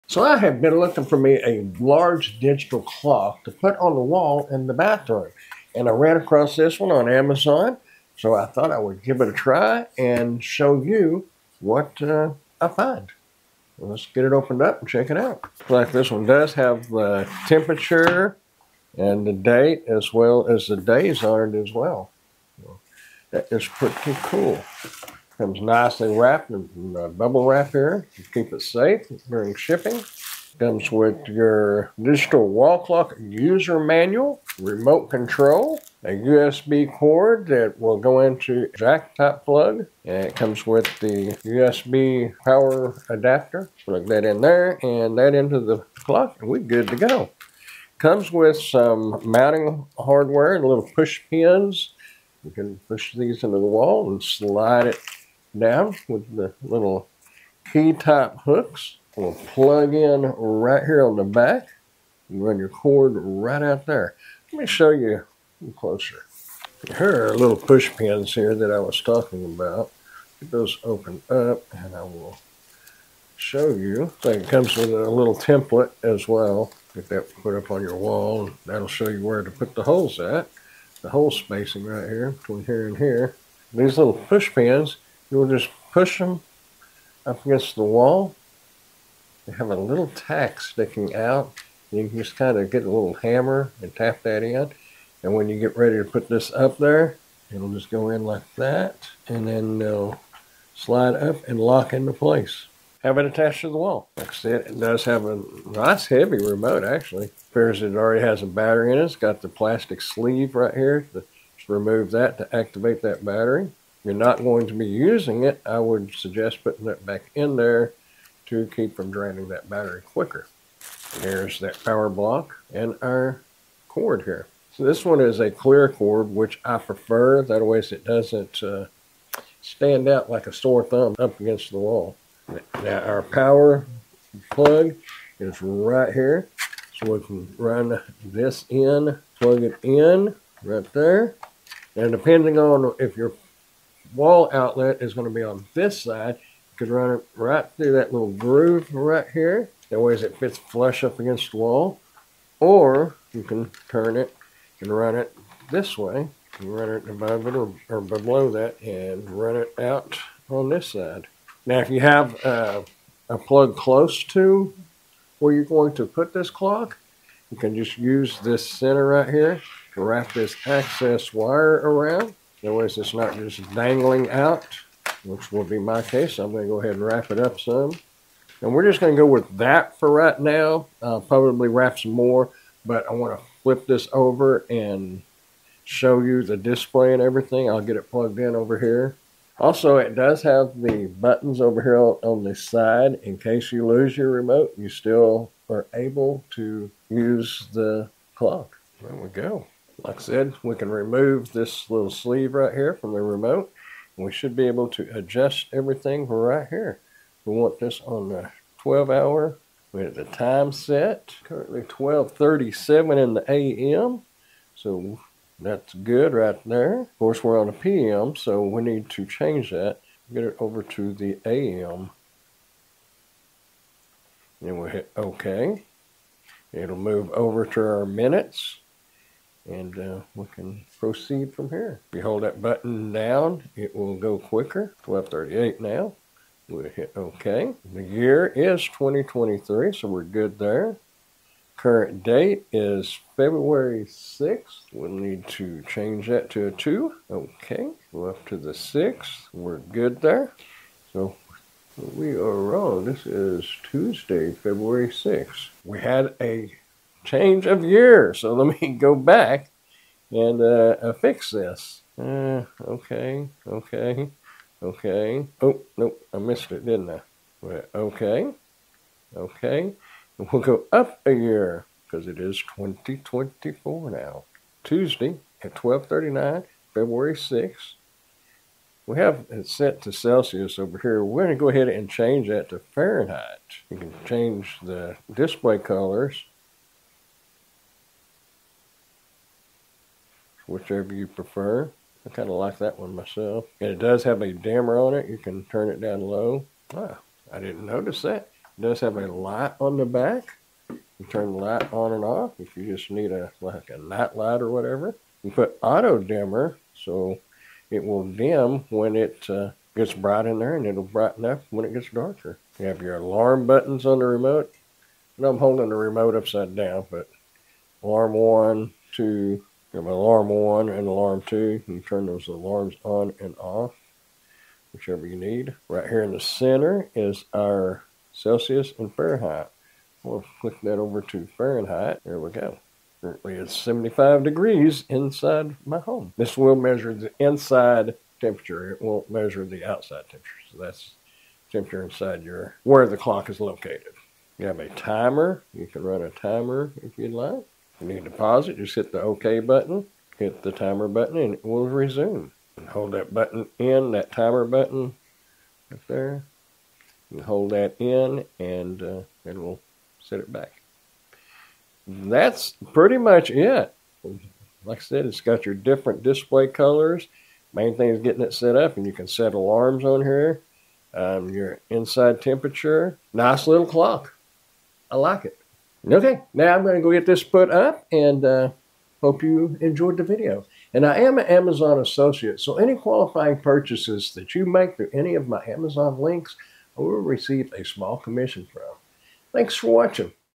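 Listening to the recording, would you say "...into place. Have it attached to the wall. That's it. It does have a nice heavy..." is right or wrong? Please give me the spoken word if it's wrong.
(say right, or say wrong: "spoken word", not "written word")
right.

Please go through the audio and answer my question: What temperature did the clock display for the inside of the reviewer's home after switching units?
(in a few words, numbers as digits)
75 degrees.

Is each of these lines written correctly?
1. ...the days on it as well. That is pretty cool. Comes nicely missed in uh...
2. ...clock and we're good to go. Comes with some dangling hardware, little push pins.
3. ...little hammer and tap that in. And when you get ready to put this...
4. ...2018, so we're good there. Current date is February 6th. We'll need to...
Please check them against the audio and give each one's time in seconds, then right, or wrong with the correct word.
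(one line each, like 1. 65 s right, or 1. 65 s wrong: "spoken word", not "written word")
1. 20 s wrong: "wrapped", not "missed"
2. 46 s wrong: "mounting", not "dangling"
3. 92 s right
4. 238 s wrong: "2023", not "2018".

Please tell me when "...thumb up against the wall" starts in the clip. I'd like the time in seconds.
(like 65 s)
130 s.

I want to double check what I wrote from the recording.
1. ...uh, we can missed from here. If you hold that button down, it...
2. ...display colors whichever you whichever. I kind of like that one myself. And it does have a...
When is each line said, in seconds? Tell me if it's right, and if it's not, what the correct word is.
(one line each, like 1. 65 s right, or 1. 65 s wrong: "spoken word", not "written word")
1. 229 s wrong: "proceed", not "missed"
2. 285 s wrong: "prefer", not "whichever".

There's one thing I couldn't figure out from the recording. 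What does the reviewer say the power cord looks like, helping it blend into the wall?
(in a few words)
clear.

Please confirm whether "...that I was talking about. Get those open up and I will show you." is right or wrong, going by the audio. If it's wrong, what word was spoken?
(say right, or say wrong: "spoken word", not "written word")
right.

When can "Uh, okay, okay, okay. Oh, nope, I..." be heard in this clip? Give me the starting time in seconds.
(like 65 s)
262 s.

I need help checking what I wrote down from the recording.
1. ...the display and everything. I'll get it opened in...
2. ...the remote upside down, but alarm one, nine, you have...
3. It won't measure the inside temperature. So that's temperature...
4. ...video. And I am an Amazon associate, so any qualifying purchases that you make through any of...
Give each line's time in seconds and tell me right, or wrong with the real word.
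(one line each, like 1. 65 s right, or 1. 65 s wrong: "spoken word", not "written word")
1. 186 s wrong: "plugged", not "opened"
2. 315 s wrong: "two", not "nine"
3. 338 s wrong: "outside", not "inside"
4. 380 s right.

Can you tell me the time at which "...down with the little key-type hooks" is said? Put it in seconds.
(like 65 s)
55 s.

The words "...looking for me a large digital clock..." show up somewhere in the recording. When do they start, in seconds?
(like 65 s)
0 s.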